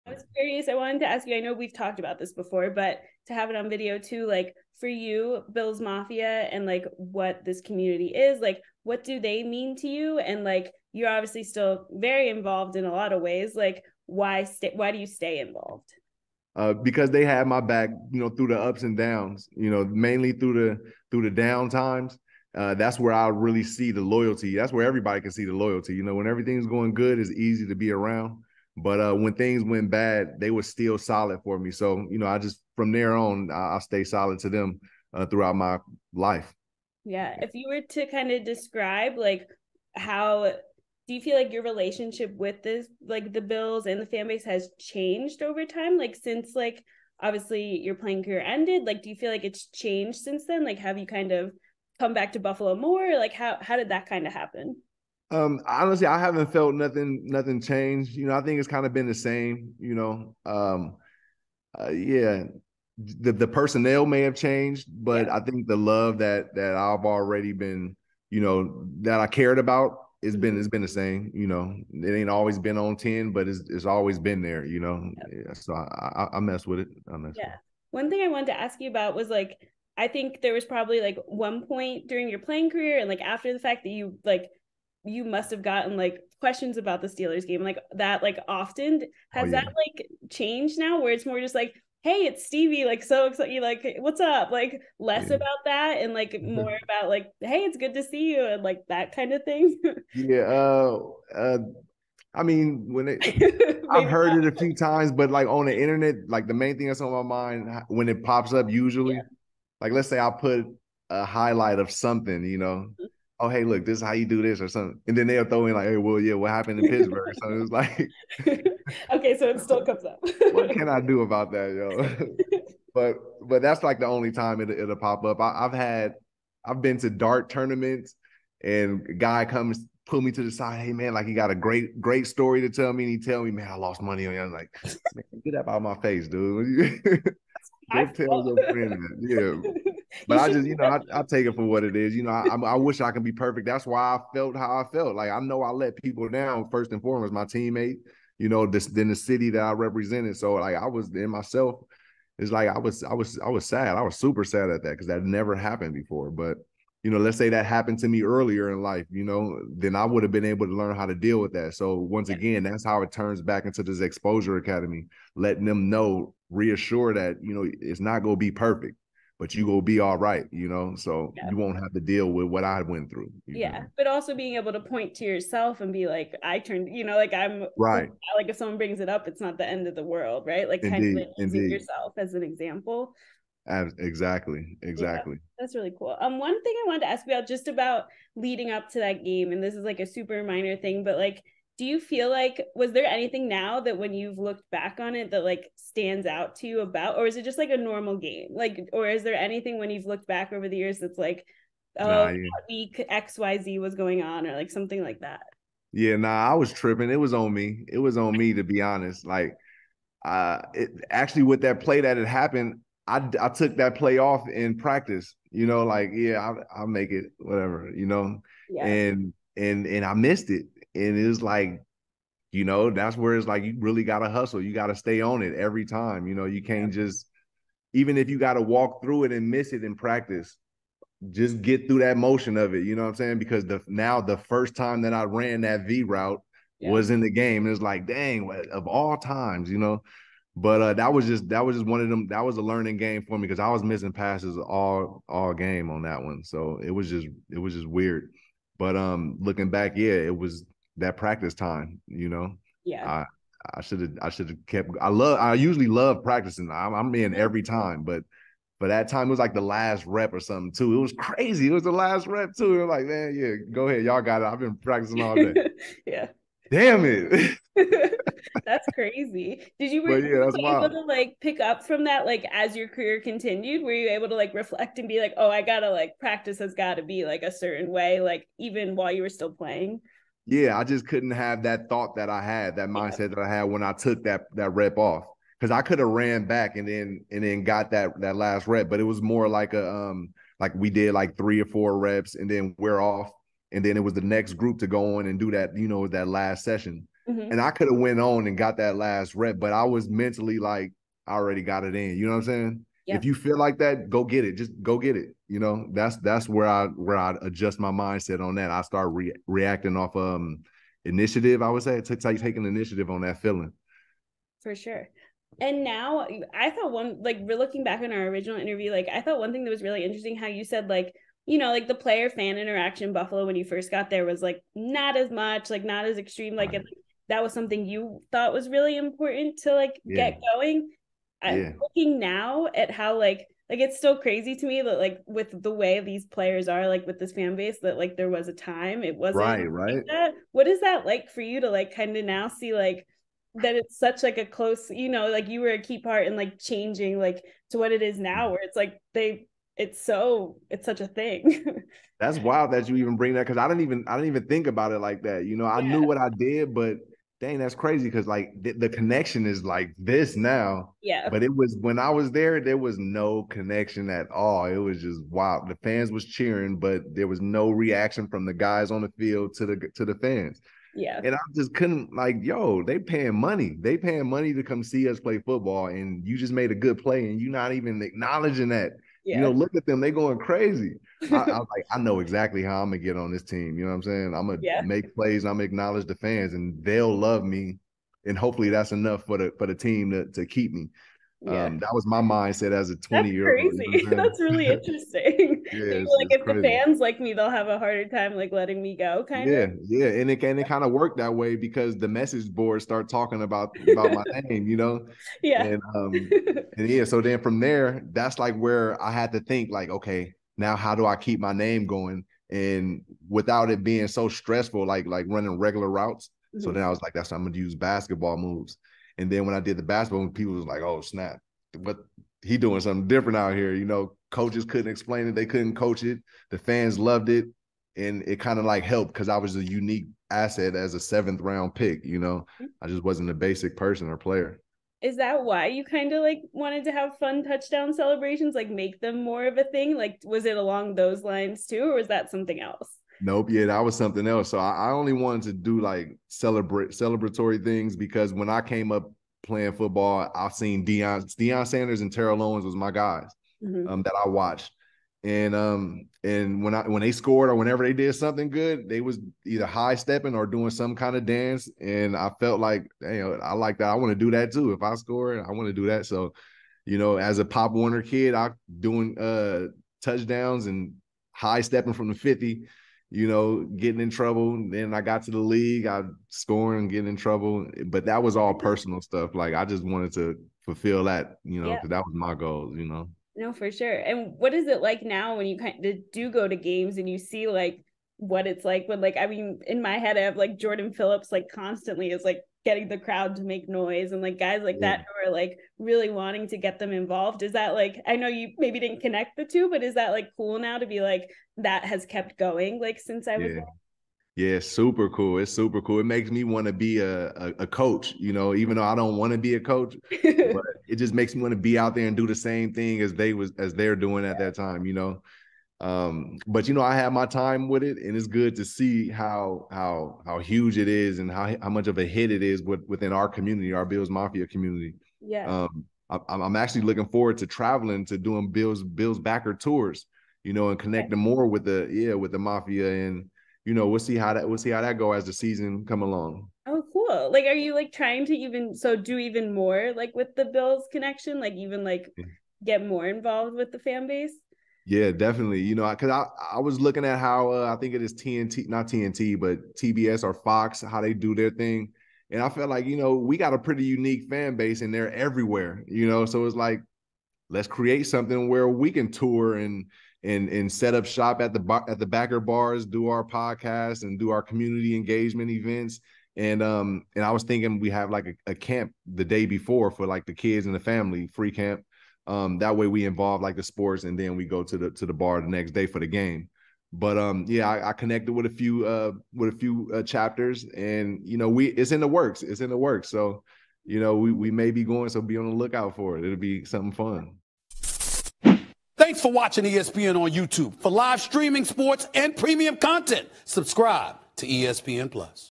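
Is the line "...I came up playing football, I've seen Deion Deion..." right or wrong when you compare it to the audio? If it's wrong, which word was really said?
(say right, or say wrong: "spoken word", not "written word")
right.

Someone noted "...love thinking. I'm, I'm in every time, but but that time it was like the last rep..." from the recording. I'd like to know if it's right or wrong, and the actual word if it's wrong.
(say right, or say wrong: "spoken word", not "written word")
wrong: "practicing", not "thinking".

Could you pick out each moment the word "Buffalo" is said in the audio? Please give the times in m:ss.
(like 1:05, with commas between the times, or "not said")
0:52, 5:23.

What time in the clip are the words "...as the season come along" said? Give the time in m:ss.
8:55.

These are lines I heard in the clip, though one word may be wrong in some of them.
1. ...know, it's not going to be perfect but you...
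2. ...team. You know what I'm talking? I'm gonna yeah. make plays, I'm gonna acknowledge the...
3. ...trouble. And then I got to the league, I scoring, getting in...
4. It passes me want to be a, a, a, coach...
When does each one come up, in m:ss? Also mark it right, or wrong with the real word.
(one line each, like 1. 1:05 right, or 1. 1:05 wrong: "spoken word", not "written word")
1. 2:47 right
2. 6:23 wrong: "saying", not "talking"
3. 7:54 right
4. 8:25 wrong: "makes", not "passes".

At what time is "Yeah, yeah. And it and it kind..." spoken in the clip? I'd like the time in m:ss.
6:39.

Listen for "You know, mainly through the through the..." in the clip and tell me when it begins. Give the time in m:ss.
0:19.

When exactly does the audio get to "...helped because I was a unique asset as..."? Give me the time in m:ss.
7:08.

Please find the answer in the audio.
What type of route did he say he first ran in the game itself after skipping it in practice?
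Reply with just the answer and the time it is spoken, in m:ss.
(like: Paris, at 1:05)
V route, at 3:55.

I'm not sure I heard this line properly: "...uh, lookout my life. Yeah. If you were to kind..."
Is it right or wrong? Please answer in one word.
wrong.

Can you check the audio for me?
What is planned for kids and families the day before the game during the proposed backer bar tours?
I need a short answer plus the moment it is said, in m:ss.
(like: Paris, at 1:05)
Free camp, at 9:31.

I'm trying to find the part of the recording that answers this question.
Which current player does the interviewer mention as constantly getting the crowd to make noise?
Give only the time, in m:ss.
8:10.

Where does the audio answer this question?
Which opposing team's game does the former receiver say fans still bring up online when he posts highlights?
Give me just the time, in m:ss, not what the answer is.
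1:27.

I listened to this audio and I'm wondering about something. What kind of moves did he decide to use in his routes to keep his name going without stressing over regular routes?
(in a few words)
Basketball moves.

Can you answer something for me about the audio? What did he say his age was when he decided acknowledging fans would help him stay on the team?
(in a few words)
20.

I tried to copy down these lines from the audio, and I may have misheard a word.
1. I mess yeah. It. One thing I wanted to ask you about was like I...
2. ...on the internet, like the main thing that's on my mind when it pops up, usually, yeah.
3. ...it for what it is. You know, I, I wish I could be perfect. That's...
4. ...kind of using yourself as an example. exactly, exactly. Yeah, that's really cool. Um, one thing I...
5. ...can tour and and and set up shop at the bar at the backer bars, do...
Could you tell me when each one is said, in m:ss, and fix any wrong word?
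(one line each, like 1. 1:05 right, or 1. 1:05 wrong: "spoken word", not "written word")
1. 1:17 right
2. 1:45 right
3. 2:21 right
4. 3:01 right
5. 9:18 right.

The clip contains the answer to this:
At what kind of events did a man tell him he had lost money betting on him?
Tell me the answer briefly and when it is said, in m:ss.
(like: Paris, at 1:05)
Dart tournaments, at 2:07.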